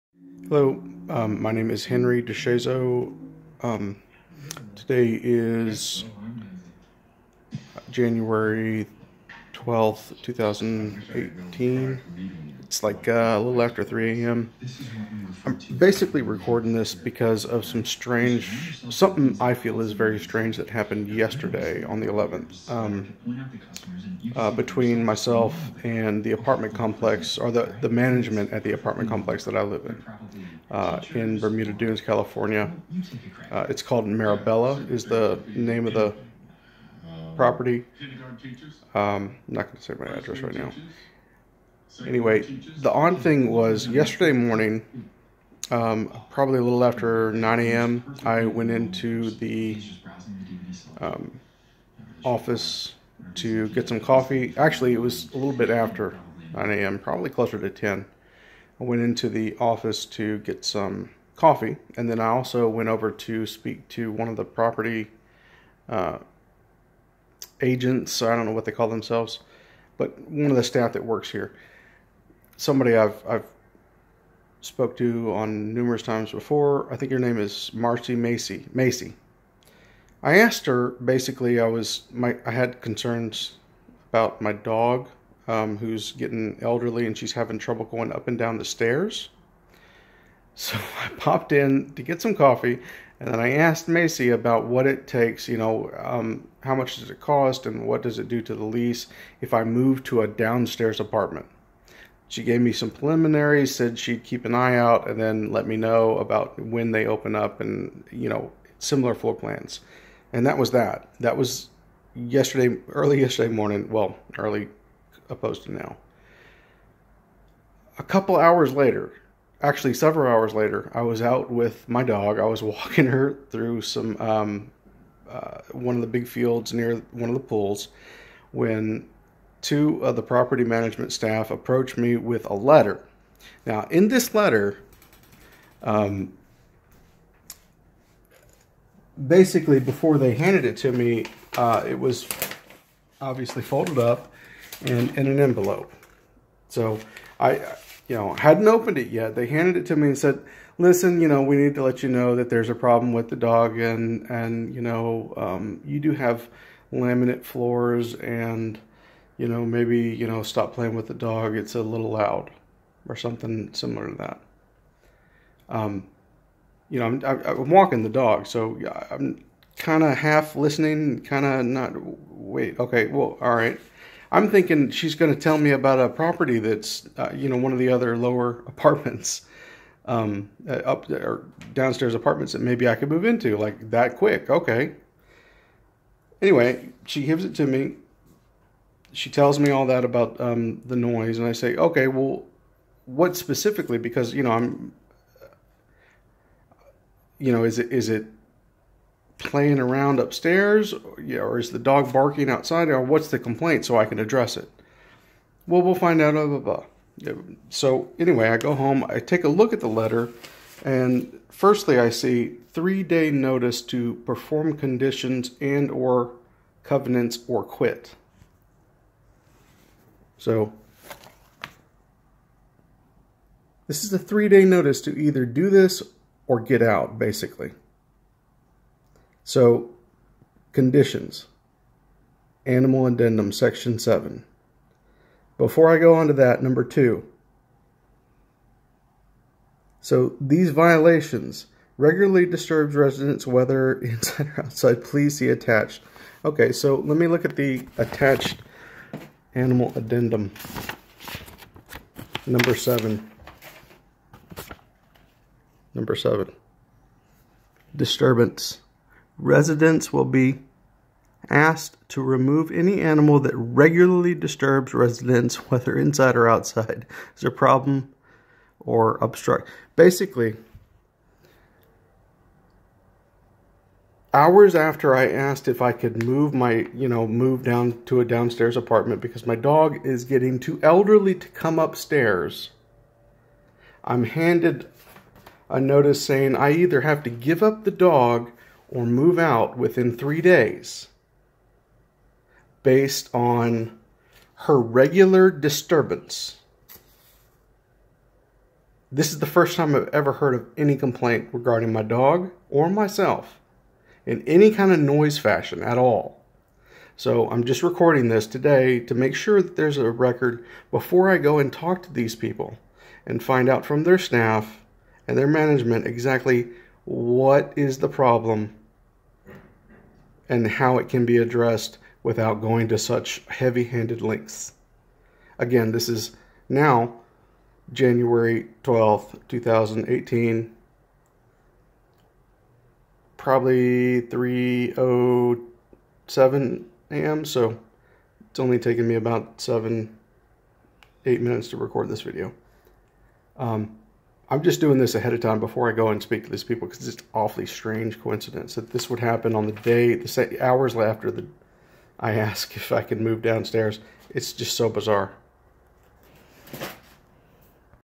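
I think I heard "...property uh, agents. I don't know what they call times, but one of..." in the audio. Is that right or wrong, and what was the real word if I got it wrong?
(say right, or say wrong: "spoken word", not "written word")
wrong: "themselves", not "times".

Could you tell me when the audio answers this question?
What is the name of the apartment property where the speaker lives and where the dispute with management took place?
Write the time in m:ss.
0:34.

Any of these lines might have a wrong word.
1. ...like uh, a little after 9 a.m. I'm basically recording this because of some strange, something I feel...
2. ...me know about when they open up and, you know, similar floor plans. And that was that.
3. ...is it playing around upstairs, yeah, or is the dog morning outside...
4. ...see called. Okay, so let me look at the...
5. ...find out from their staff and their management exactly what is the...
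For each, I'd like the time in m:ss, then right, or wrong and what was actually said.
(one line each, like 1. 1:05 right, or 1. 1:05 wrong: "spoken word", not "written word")
1. 0:12 wrong: "3", not "9"
2. 1:45 right
3. 3:17 wrong: "barking", not "morning"
4. 4:05 wrong: "attached", not "called"
5. 5:13 right.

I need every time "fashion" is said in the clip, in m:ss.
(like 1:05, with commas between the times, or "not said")
5:05.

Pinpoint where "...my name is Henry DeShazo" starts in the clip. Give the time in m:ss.
0:01.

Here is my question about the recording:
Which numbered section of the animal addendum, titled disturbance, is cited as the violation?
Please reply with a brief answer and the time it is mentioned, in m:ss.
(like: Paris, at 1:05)
7, at 3:53.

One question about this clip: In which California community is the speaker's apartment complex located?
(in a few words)
Bermuda Dunes.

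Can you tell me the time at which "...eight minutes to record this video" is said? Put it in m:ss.
5:41.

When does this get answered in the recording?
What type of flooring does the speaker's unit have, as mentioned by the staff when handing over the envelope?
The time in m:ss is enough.
2:36.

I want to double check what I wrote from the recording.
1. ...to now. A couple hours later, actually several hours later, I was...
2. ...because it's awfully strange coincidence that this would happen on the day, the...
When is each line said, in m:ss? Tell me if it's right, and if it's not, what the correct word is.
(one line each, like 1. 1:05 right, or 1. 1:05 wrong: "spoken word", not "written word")
1. 1:55 right
2. 5:46 right.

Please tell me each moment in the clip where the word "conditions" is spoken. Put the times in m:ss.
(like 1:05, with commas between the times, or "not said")
3:34, 3:50.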